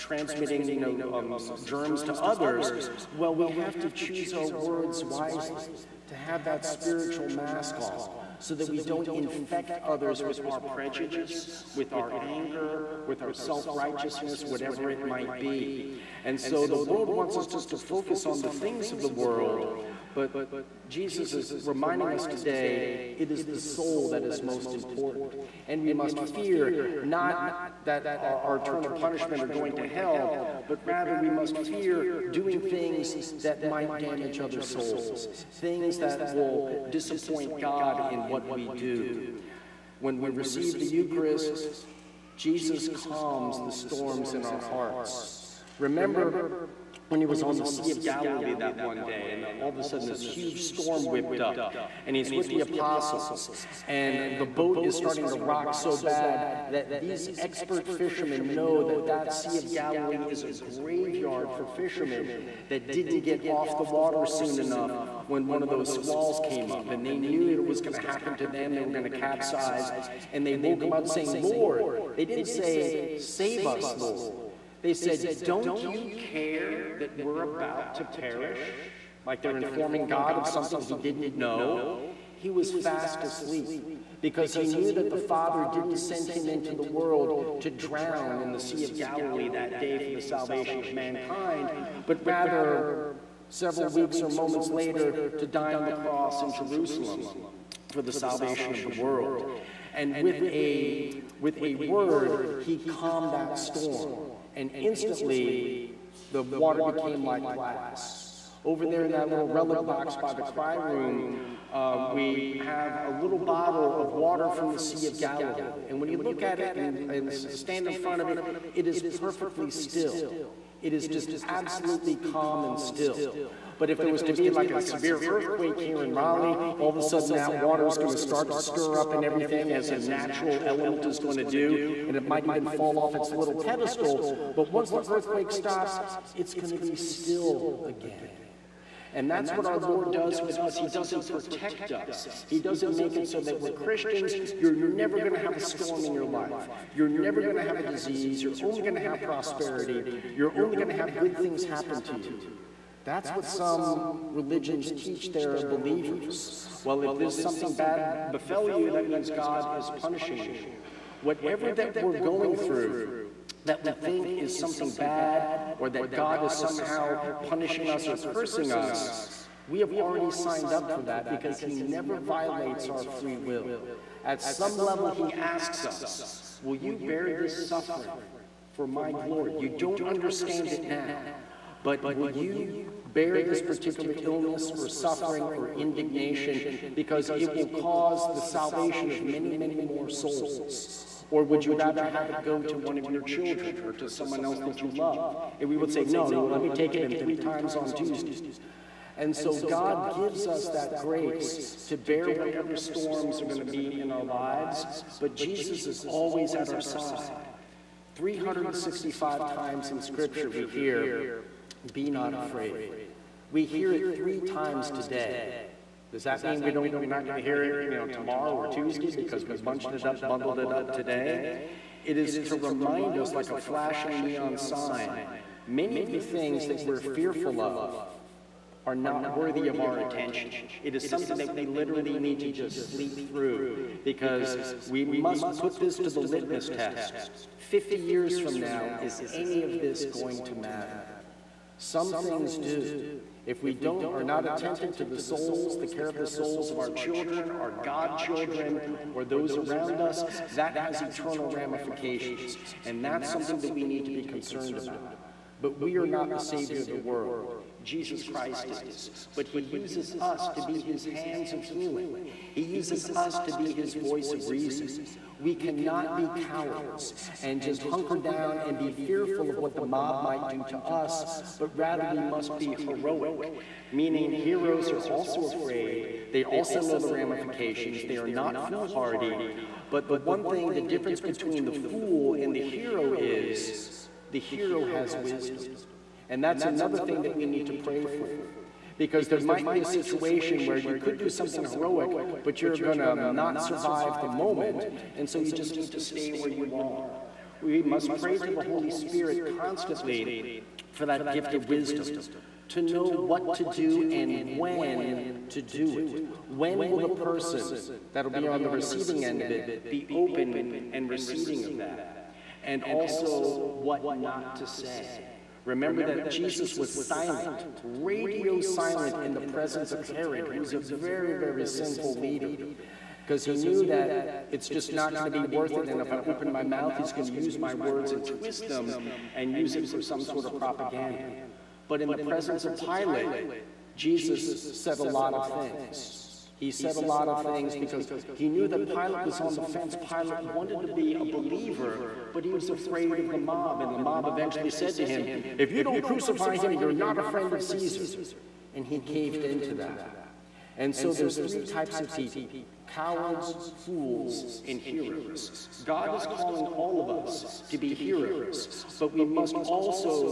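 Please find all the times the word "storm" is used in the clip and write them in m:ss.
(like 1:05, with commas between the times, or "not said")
0:43, 0:50, 1:43, 2:25, 3:22.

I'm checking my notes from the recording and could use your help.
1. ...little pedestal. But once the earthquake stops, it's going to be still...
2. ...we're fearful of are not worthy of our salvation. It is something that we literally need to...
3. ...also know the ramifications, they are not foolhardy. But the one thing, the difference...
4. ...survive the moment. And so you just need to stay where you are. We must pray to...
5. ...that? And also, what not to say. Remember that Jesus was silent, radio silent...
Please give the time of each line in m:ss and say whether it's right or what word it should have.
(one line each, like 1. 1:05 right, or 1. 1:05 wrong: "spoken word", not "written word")
1. 2:13 right
2. 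3:46 wrong: "attention", not "salvation"
3. 4:36 right
4. 4:53 right
5. 5:11 right.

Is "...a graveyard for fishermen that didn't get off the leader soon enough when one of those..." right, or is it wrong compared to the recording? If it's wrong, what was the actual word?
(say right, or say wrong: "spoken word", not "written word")
wrong: "water", not "leader".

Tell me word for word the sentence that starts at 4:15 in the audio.
But we are not the Savior of the world.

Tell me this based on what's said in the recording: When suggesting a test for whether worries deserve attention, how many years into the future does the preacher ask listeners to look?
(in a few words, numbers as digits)
50.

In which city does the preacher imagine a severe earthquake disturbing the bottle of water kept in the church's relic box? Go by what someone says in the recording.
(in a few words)
Raleigh.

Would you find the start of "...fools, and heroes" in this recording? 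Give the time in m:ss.
5:53.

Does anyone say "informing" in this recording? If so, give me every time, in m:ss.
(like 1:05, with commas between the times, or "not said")
1:19.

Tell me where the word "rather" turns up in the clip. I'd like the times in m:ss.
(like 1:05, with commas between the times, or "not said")
0:30, 1:32, 3:11, 4:31.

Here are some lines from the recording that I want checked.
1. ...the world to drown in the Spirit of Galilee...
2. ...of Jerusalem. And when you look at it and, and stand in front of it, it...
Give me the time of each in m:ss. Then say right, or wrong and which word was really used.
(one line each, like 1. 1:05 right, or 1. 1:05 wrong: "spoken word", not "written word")
1. 1:26 wrong: "Sea", not "Spirit"
2. 1:55 wrong: "Galilee", not "Jerusalem".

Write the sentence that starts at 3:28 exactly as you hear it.
365 times in Scripture we hear, be not afraid.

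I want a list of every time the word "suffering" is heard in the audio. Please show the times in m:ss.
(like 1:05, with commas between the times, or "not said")
2:57, 3:04.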